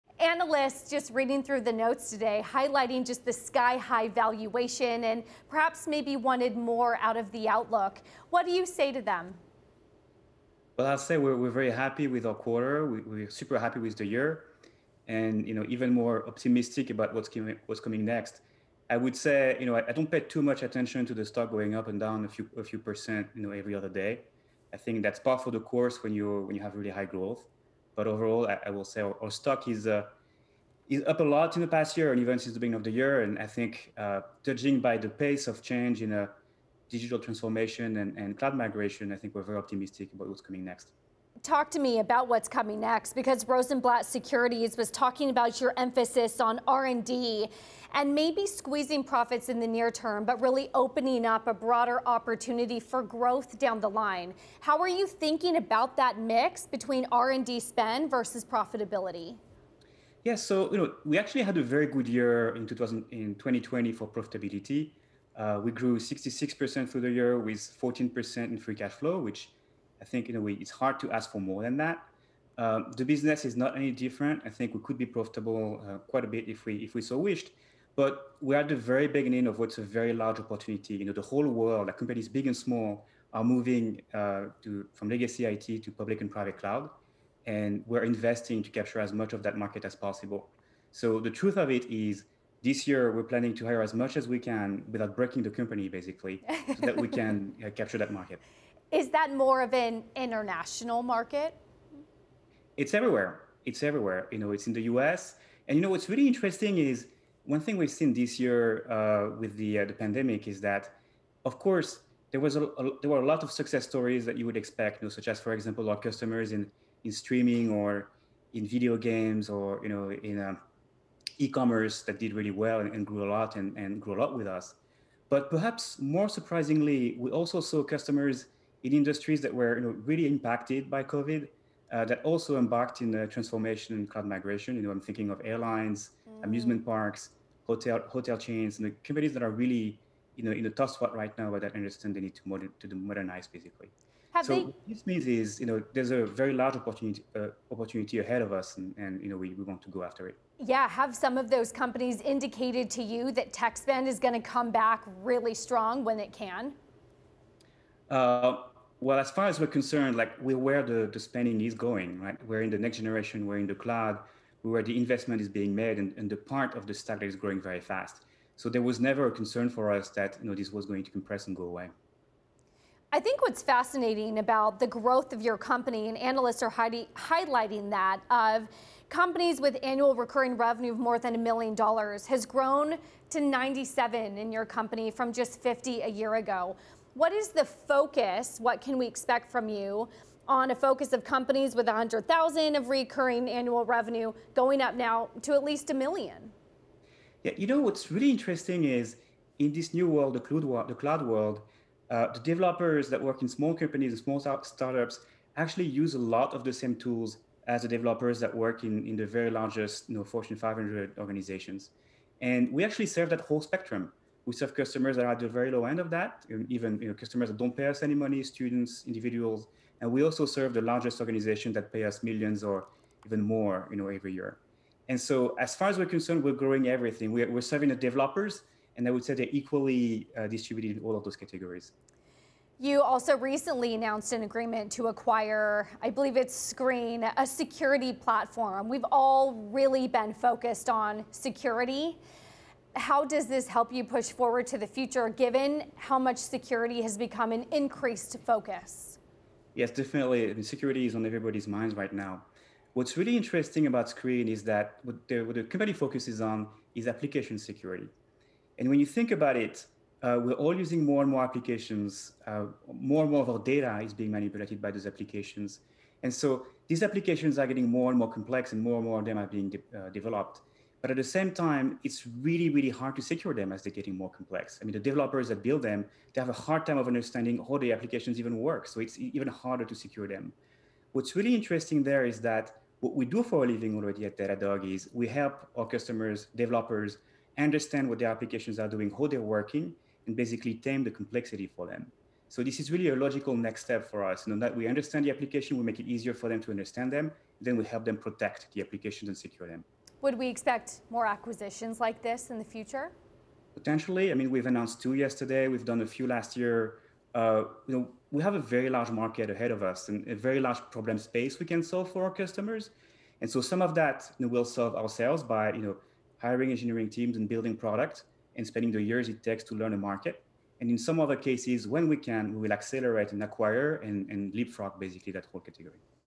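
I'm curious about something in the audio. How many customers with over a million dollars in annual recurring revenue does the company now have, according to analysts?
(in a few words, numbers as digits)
97.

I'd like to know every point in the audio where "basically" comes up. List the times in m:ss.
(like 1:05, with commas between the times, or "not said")
1:35, 2:23, 4:50, 5:24.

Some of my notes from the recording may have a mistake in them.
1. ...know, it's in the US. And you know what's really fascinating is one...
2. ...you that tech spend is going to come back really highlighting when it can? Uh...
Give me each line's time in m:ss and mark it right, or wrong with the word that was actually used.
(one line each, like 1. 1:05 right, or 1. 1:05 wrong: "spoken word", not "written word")
1. 1:44 wrong: "interesting", not "fascinating"
2. 2:33 wrong: "strong", not "highlighting".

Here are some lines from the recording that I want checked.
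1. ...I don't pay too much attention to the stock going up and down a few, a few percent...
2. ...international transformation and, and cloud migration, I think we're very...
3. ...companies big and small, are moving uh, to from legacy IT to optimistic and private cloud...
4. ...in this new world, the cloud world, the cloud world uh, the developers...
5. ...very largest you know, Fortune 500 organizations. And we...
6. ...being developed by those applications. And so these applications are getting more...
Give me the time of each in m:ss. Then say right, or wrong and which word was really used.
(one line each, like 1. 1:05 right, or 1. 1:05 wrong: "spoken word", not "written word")
1. 0:19 right
2. 0:36 wrong: "digital", not "international"
3. 1:21 wrong: "public", not "optimistic"
4. 3:19 right
5. 3:29 right
6. 4:24 wrong: "manipulated", not "developed".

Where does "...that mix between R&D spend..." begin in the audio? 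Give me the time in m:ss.
0:55.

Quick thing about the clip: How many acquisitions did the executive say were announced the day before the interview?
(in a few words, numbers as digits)
2.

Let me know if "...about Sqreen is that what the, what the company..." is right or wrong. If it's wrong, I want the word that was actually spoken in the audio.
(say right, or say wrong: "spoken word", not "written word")
right.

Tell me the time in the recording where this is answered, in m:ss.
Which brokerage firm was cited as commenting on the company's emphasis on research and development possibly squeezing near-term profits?
0:43.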